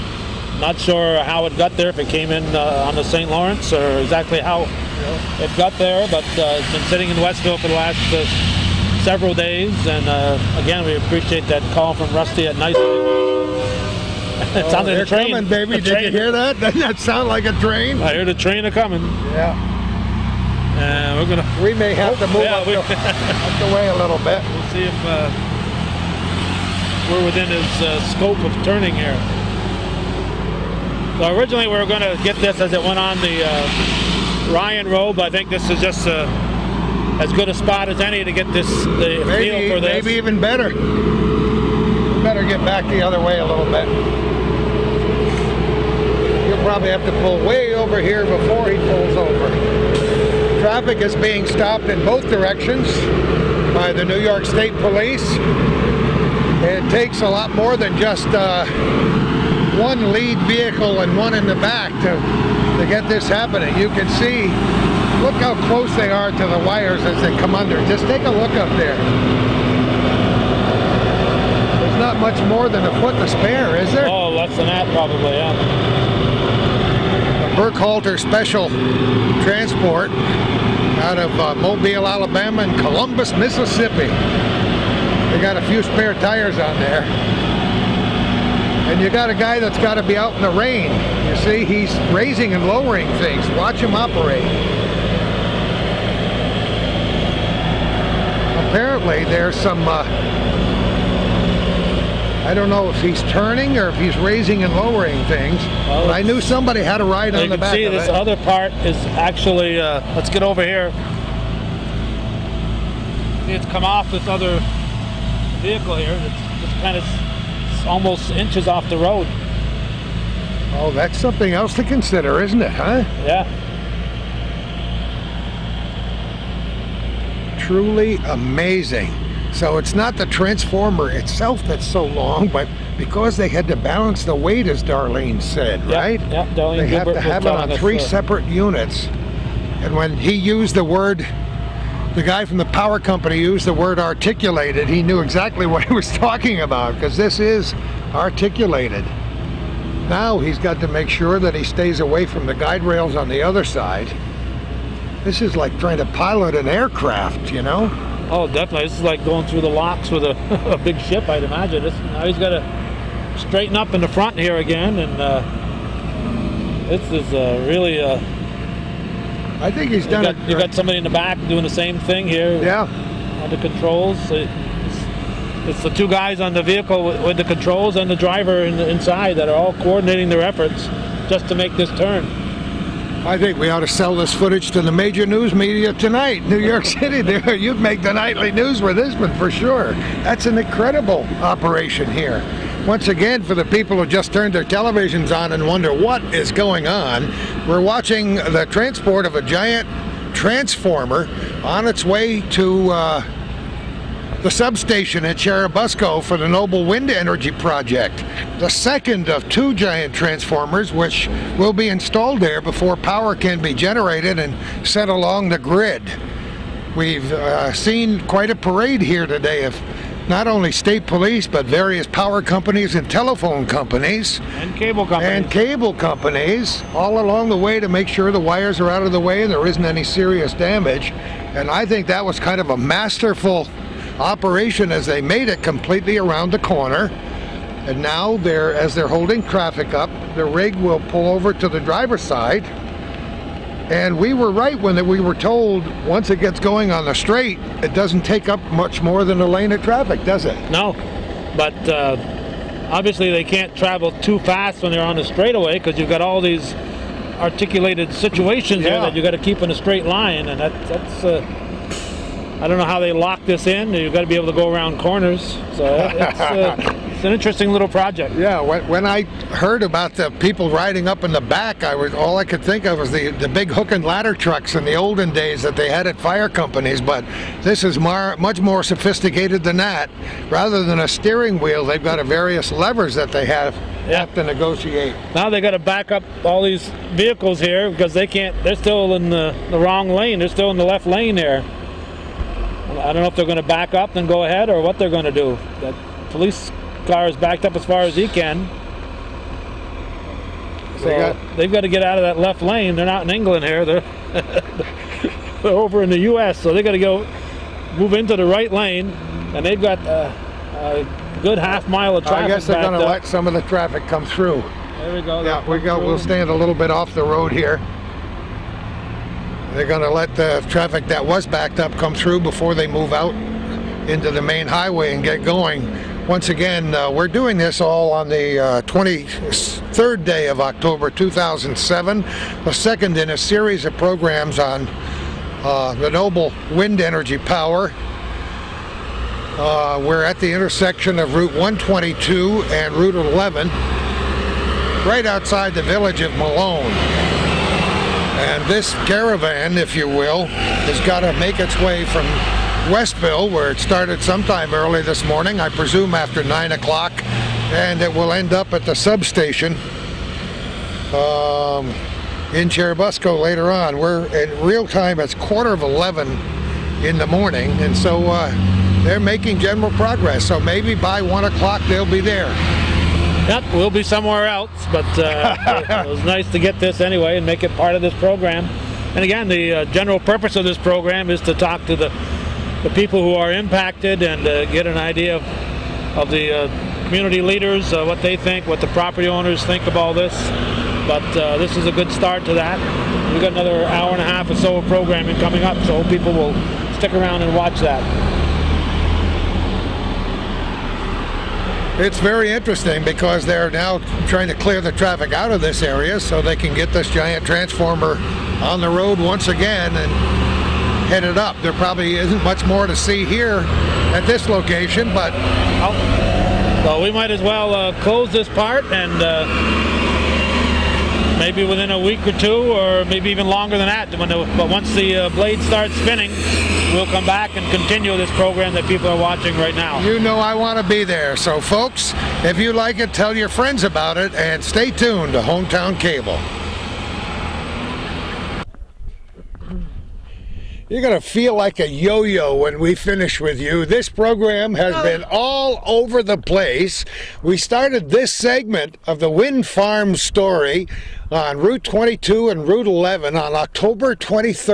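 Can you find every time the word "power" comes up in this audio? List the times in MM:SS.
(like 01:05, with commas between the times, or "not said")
02:22, 03:32, 03:42, 05:37.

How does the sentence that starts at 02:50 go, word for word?
You got somebody in the back doing the same thing here.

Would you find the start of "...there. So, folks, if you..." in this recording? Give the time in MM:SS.
07:11.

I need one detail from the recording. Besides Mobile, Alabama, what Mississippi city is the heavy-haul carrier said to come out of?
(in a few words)
Columbus.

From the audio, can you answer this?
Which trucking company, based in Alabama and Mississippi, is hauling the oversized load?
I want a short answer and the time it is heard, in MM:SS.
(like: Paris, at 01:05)
Burkhalter Special Transport, at 01:17.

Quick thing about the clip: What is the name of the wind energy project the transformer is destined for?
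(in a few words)
Noble Wind Energy Project.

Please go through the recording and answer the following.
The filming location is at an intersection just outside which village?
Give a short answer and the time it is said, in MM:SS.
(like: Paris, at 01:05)
Malone, at 05:46.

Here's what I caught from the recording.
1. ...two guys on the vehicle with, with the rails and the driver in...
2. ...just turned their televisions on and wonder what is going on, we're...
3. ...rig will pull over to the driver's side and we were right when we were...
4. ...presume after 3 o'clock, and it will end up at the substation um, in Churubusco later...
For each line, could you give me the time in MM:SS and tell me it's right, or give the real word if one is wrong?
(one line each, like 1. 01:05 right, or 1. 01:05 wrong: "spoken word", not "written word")
1. 02:55 wrong: "controls", not "rails"
2. 03:14 right
3. 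04:00 right
4. 05:55 wrong: "9", not "3".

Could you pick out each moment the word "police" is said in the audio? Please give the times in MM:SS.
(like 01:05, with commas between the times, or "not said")
00:54, 03:41, 04:56.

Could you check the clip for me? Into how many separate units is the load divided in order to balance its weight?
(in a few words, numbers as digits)
3.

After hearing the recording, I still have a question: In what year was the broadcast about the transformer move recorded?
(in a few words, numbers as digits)
2007.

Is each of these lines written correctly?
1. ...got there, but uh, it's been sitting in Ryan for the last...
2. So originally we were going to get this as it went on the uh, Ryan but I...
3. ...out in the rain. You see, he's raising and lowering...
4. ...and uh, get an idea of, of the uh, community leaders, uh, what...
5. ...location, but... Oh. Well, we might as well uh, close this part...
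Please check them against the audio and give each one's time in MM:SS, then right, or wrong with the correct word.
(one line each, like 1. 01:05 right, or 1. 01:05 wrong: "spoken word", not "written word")
1. 00:05 wrong: "Westville", not "Ryan"
2. 00:31 right
3. 01:30 right
4. 06:24 right
5. 06:54 right.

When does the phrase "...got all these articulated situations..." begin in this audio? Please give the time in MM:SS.
04:16.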